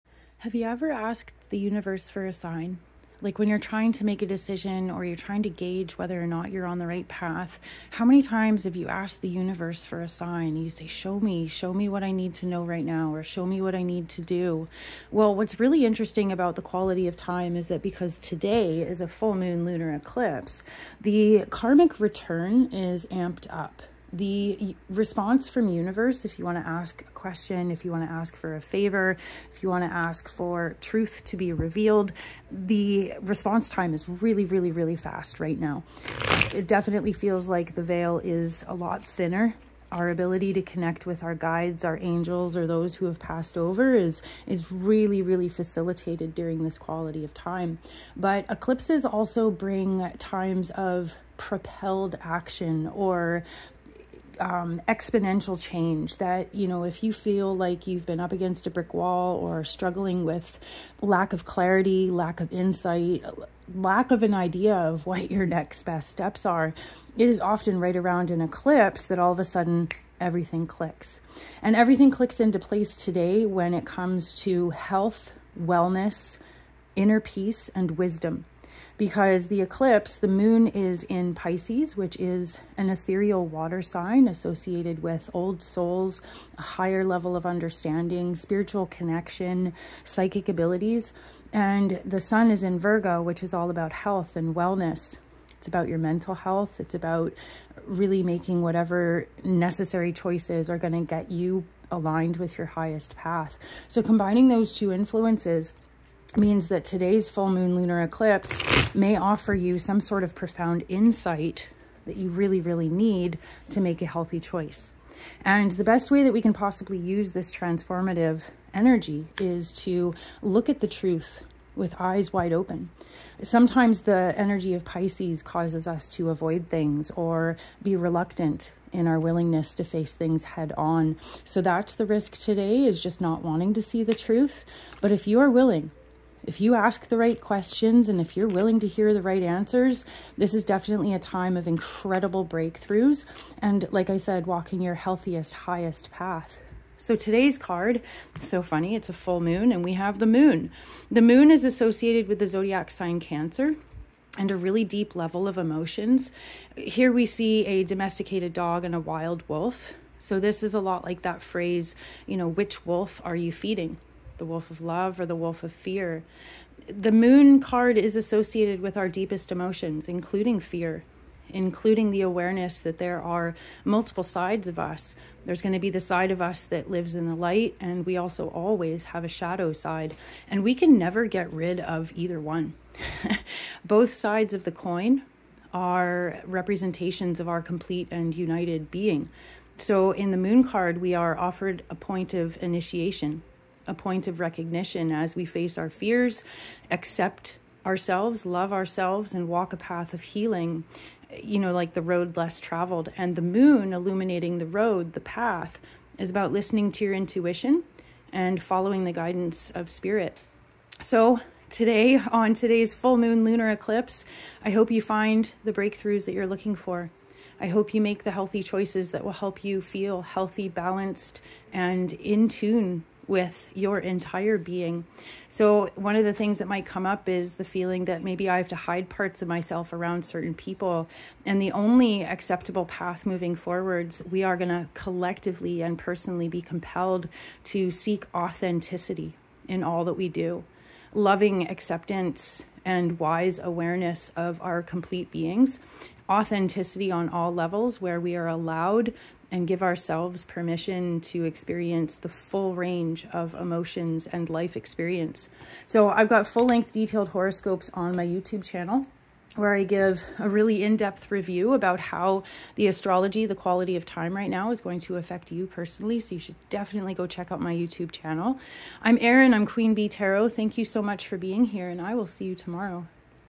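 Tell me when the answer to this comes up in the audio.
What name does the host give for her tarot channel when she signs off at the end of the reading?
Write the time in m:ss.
4:29.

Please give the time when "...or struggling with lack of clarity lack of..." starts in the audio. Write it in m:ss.
0:59.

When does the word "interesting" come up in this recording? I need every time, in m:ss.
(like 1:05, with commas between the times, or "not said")
0:15.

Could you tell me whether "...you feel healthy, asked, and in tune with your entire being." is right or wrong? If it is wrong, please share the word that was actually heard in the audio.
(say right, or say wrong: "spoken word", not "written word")
wrong: "balanced", not "asked".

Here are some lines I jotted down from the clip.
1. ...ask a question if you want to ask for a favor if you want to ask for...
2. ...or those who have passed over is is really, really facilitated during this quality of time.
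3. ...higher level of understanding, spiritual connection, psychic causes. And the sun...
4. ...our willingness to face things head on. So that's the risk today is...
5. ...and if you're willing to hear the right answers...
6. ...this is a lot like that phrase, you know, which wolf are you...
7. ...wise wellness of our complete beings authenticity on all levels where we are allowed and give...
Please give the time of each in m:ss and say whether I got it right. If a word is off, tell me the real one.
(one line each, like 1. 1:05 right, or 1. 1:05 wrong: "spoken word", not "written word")
1. 0:26 right
2. 0:42 right
3. 1:26 wrong: "abilities", not "causes"
4. 2:09 right
5. 2:18 right
6. 2:40 right
7. 4:03 wrong: "awareness", not "wellness".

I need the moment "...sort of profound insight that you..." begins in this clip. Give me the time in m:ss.
1:49.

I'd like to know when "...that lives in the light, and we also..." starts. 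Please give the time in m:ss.
2:56.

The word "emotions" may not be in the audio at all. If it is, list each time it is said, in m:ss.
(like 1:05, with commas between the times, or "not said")
2:35, 2:49, 4:13.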